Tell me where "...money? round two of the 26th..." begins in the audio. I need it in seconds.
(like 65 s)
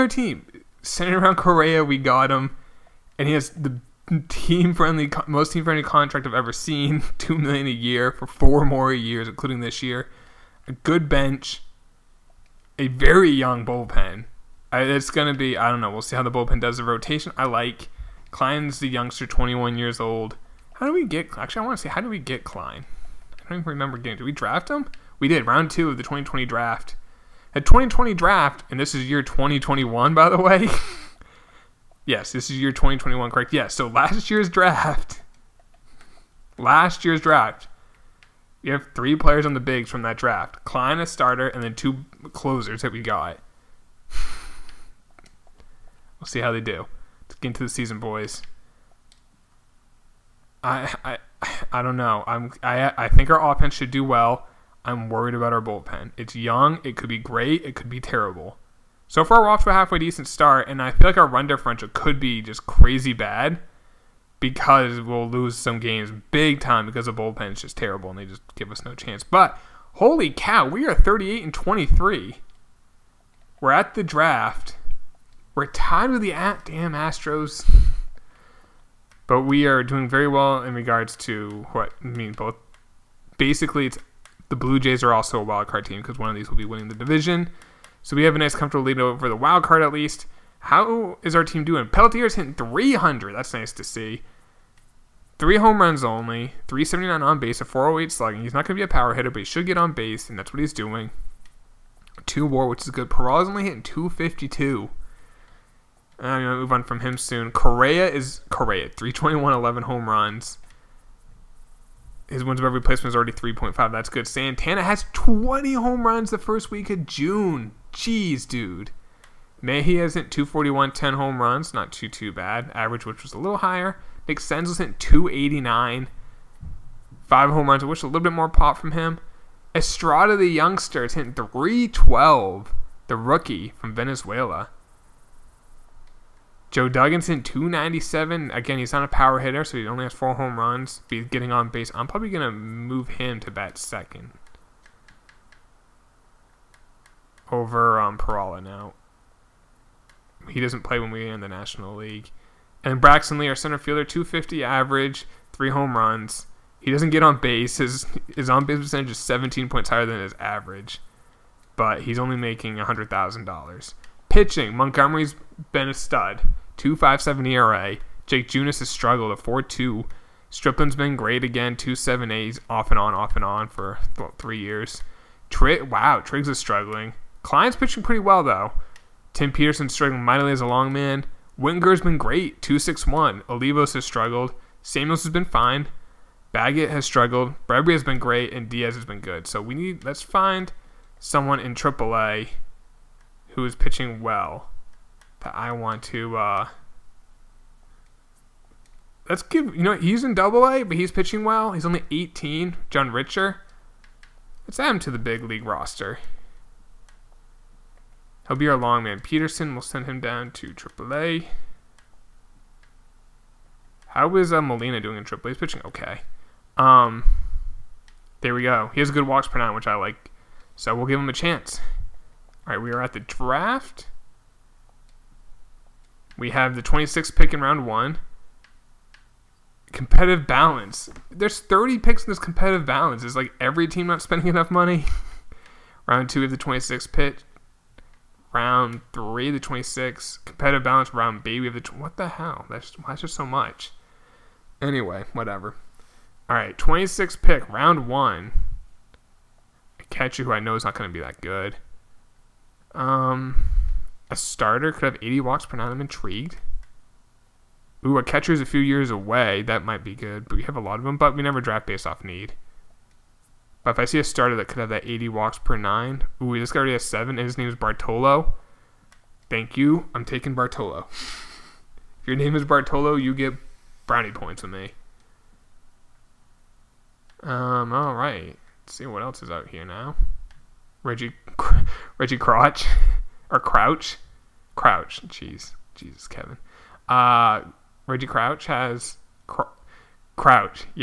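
234 s.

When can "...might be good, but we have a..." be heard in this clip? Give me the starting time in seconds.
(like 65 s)
259 s.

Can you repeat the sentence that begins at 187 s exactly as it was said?
Bradbury has been great, and Diaz has been good.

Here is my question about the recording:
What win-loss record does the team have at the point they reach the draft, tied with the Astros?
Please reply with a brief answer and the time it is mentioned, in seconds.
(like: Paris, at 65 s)
38 and 23, at 70 s.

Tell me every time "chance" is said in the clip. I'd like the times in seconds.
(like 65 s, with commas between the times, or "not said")
68 s, 221 s.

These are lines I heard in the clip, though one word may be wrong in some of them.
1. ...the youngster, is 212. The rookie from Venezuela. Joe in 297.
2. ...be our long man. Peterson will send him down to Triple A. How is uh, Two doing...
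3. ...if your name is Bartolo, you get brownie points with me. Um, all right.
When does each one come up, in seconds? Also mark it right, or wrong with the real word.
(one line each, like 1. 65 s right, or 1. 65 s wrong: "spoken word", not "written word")
1. 130 s wrong: "312", not "212"
2. 208 s wrong: "Molina", not "Two"
3. 271 s right.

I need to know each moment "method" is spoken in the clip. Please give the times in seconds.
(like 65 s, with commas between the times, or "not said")
not said.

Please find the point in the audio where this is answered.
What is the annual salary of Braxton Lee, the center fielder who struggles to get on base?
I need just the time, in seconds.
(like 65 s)
162 s.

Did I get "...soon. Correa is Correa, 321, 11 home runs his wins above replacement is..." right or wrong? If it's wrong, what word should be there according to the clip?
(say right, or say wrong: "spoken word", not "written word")
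right.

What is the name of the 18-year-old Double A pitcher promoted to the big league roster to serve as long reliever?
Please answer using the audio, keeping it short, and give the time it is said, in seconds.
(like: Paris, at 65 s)
John Richer, at 202 s.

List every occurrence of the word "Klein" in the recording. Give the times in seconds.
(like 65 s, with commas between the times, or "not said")
18 s, 22 s, 40 s, 177 s.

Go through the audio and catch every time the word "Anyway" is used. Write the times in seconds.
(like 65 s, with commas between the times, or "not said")
244 s.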